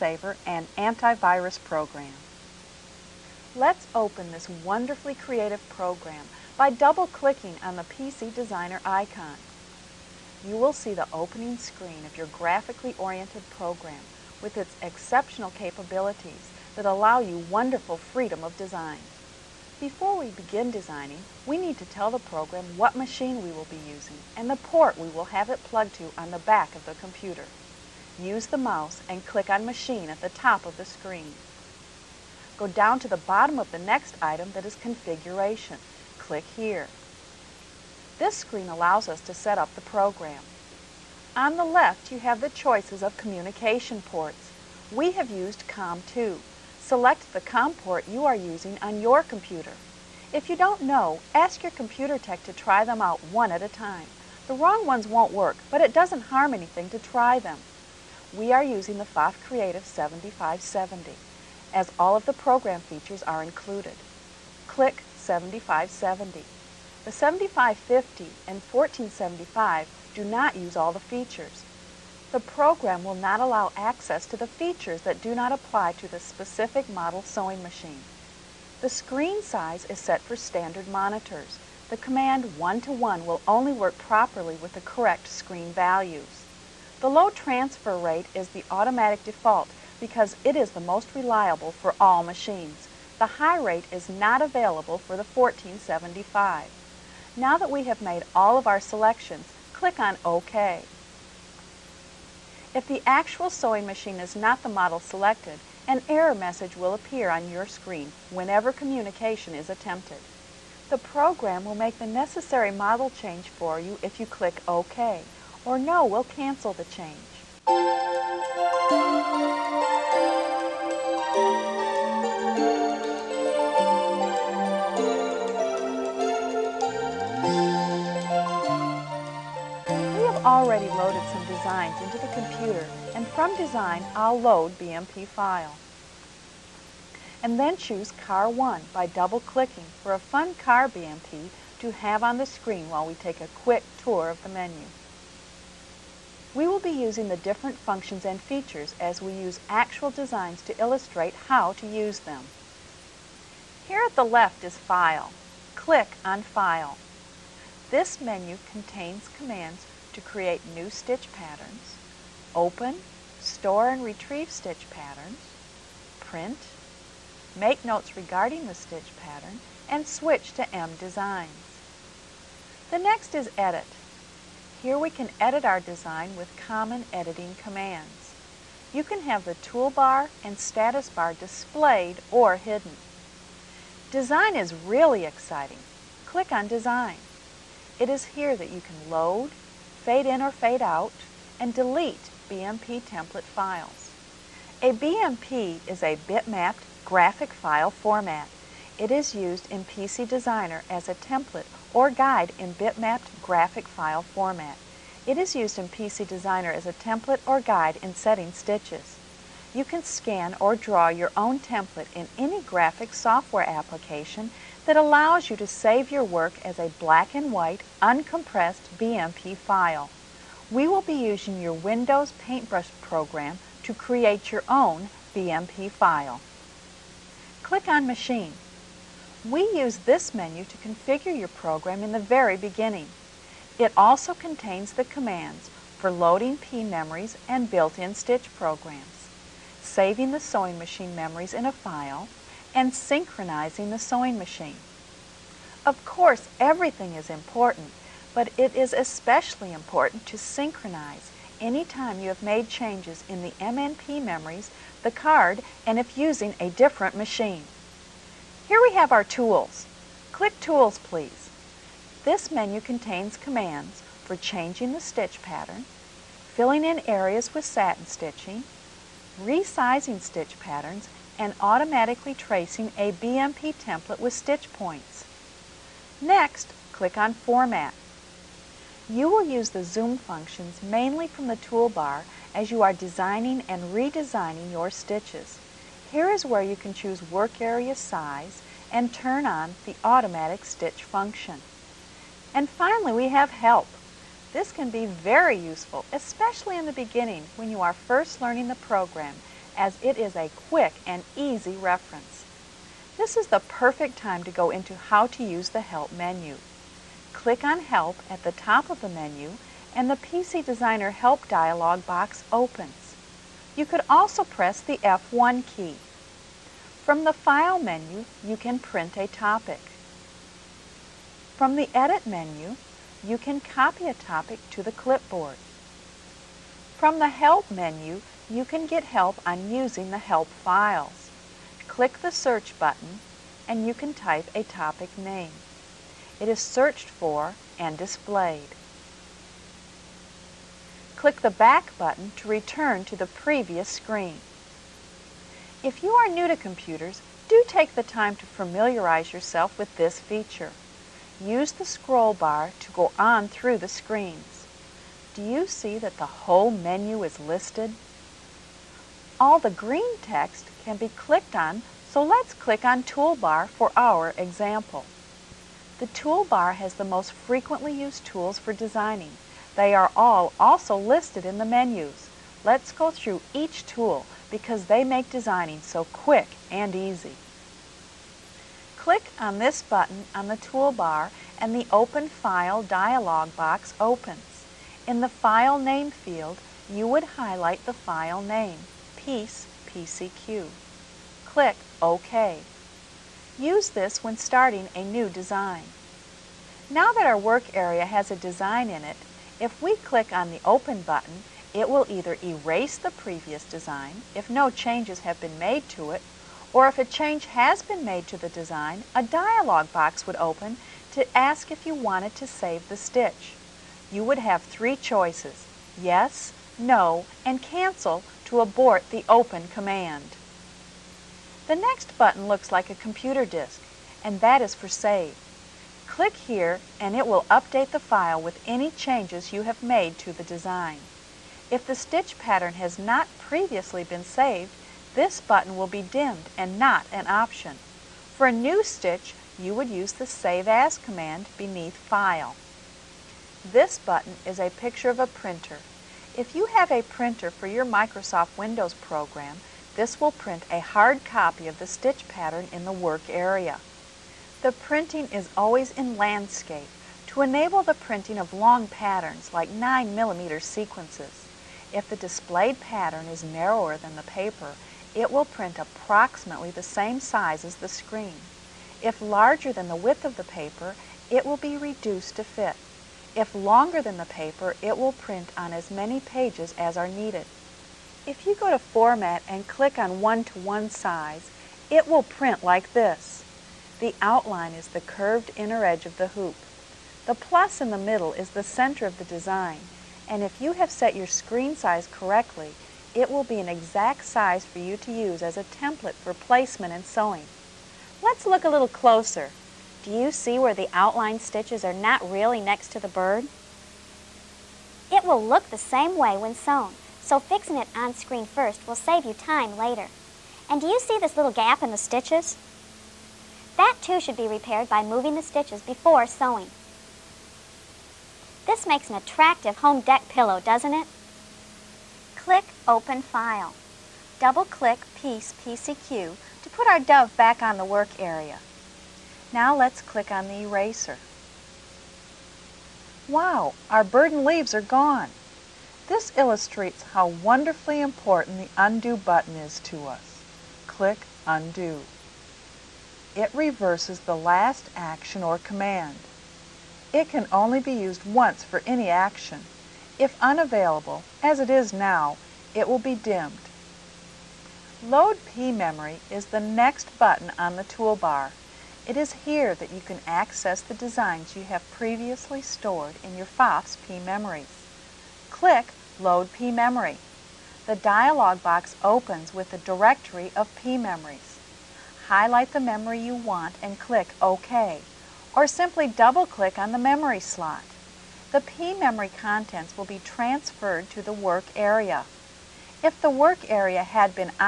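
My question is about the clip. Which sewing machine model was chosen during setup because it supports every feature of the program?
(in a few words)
Pfaff Creative 7570.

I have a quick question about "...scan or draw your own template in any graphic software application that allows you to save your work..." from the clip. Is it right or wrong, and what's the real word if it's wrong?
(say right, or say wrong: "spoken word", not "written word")
right.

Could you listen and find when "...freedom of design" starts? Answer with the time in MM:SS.
00:17.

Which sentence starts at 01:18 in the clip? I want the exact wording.
The screen size is set for standard monitors.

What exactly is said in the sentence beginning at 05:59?
All the green text can be clicked on, so let's click on Toolbar for our example.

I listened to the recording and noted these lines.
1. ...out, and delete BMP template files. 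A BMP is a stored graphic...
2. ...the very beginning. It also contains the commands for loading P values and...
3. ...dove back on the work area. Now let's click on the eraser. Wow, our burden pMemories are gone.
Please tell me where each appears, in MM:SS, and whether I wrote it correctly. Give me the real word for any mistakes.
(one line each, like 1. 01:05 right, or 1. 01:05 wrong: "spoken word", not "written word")
1. 03:10 wrong: "bitmapped", not "stored"
2. 03:52 wrong: "memories", not "values"
3. 08:46 wrong: "leaves", not "pMemories".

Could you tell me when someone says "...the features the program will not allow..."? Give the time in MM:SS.
01:10.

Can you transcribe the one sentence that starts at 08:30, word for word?
And do you see this little gap in the stitches?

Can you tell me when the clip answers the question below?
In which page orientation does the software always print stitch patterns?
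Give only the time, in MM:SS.
07:36.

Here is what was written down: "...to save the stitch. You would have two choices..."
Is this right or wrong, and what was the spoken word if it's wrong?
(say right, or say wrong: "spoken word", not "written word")
wrong: "three", not "two".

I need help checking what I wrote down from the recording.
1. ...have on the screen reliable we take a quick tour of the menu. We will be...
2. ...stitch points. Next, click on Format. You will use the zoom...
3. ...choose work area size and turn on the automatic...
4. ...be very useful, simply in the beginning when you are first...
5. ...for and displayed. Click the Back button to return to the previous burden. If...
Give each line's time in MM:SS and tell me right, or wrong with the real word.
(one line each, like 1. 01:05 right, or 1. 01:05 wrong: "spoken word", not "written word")
1. 02:21 wrong: "while", not "reliable"
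2. 04:34 right
3. 04:46 right
4. 04:54 wrong: "especially", not "simply"
5. 05:37 wrong: "screen", not "burden".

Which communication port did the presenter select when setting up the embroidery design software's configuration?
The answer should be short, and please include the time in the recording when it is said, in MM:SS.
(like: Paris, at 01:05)
COM2, at 00:45.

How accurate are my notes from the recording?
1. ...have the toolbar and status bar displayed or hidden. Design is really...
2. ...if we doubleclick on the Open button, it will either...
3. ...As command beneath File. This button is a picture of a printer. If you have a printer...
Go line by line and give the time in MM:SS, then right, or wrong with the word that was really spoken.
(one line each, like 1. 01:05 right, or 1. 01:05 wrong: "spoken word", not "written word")
1. 02:59 right
2. 06:39 wrong: "click", not "doubleclick"
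3. 07:20 right.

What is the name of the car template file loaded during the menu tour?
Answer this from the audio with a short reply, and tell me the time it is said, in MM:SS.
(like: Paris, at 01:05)
Car 1, at 02:18.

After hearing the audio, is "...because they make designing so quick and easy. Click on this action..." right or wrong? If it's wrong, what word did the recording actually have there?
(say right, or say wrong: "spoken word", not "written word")
wrong: "button", not "action".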